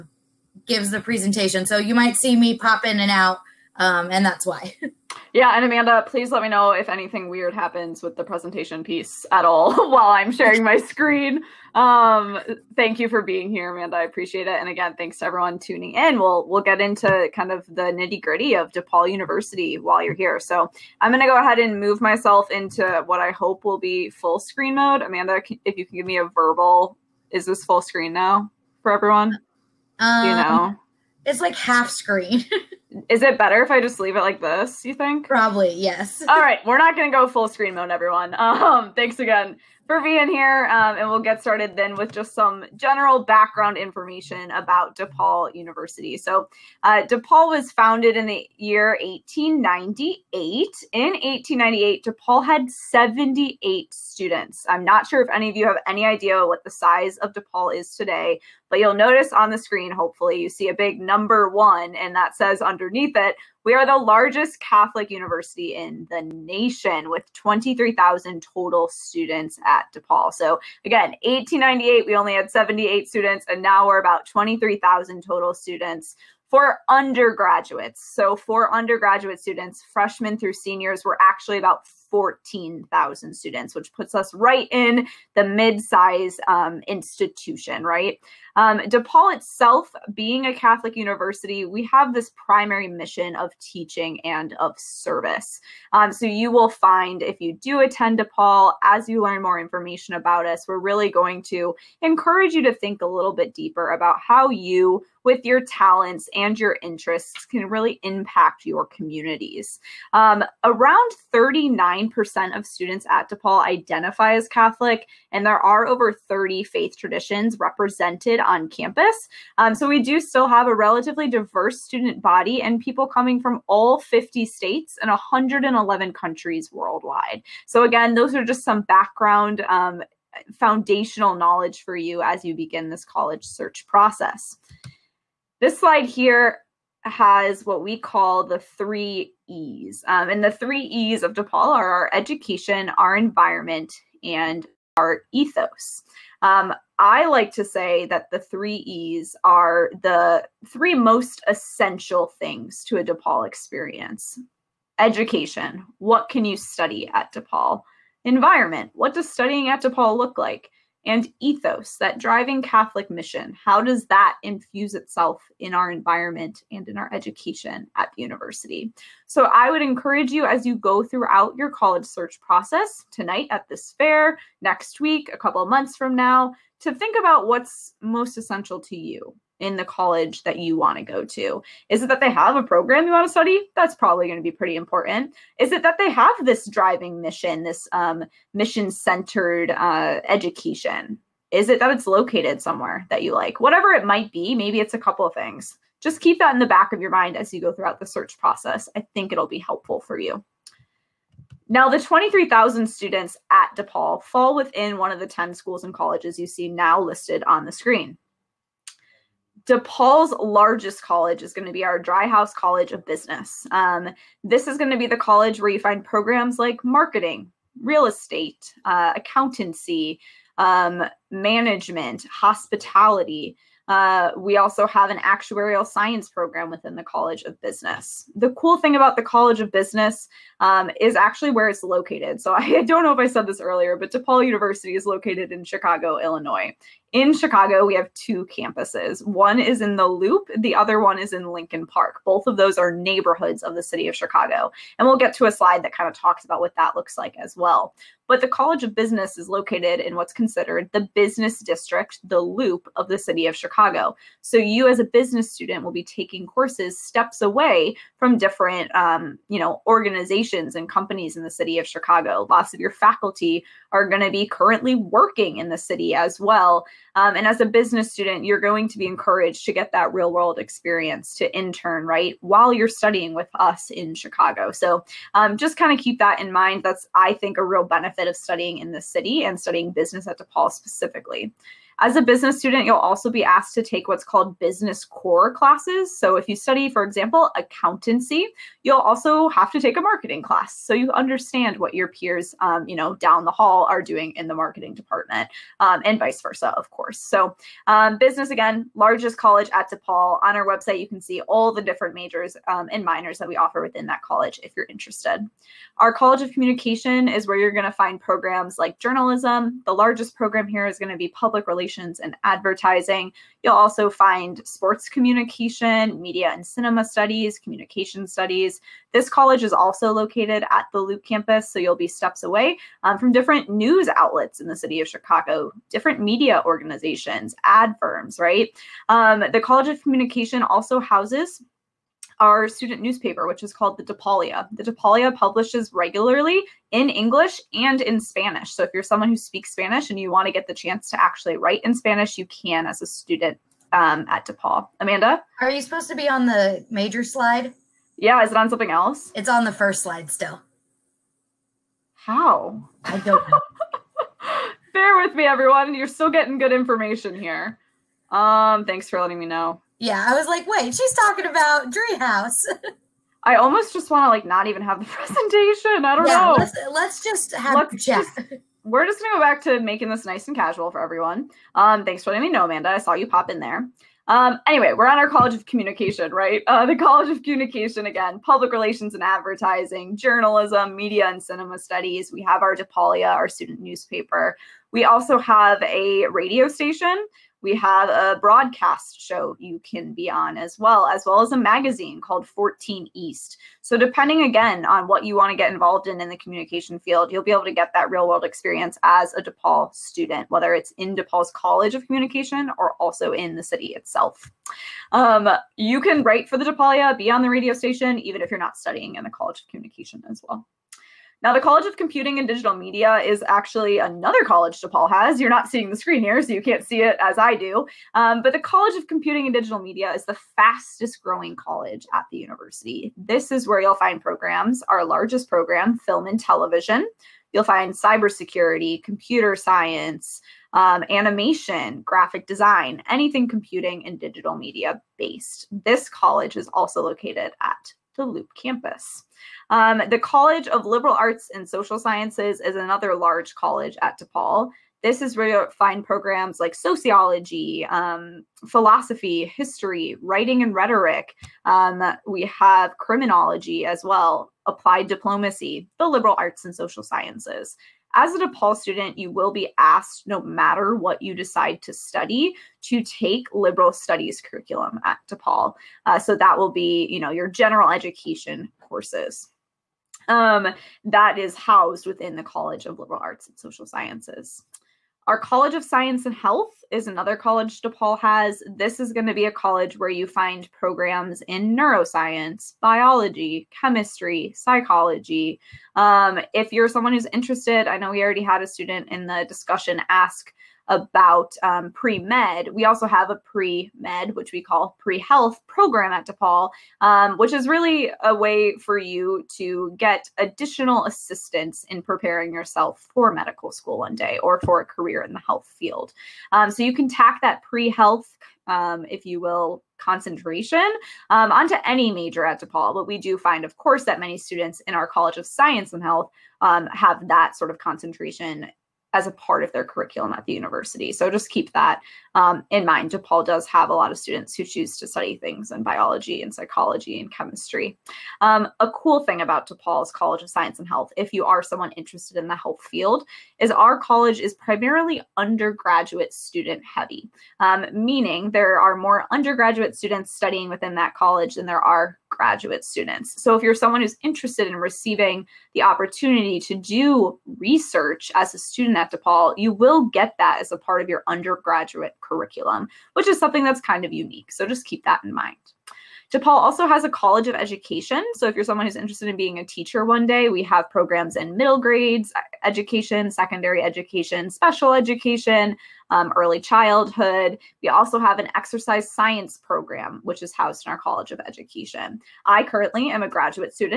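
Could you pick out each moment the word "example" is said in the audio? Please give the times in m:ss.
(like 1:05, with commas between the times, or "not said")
4:47.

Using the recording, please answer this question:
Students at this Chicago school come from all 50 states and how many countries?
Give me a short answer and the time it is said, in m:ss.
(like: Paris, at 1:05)
111, at 2:05.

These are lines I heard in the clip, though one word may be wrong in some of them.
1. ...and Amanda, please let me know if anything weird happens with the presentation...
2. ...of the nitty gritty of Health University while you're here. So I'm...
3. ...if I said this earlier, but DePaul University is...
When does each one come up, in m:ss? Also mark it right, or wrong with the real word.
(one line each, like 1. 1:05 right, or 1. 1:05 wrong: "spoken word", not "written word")
1. 0:05 right
2. 0:17 wrong: "DePaul", not "Health"
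3. 3:53 right.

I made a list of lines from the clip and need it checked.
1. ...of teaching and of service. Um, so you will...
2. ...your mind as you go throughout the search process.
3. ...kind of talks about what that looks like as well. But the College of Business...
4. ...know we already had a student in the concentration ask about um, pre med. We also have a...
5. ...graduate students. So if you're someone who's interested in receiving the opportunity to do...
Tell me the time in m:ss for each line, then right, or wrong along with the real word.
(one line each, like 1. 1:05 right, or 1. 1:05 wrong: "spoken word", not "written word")
1. 1:33 right
2. 3:16 right
3. 4:05 right
4. 8:07 wrong: "discussion", not "concentration"
5. 9:02 right.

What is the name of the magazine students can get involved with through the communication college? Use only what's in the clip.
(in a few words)
14 East.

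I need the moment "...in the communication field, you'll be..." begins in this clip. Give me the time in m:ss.
6:36.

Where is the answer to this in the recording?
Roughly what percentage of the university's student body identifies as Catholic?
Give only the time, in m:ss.
1:51.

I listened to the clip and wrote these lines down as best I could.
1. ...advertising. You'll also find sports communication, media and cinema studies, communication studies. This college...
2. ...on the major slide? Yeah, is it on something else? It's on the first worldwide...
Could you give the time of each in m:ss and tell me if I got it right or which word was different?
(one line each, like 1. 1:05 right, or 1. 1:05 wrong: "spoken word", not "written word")
1. 5:12 right
2. 5:46 wrong: "slide", not "worldwide".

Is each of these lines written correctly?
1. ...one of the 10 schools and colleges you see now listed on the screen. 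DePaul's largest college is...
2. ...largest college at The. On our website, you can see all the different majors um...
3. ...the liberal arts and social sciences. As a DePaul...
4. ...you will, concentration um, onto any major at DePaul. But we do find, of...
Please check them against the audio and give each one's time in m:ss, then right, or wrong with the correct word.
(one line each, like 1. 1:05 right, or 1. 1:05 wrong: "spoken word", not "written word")
1. 3:24 right
2. 4:58 wrong: "DePaul", not "The"
3. 7:35 right
4. 8:29 right.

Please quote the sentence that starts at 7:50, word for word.
Um, that is housed within the College of Liberal Arts and Social Sciences.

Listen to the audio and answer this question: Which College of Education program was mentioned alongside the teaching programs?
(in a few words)
Exercise science.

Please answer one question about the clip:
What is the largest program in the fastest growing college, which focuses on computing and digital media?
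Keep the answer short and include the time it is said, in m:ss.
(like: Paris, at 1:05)
Film and television, at 7:05.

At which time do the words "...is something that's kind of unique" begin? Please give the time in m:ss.
9:13.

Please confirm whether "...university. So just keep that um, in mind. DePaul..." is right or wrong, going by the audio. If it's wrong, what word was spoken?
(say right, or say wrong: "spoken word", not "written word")
right.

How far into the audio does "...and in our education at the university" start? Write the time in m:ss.
2:46.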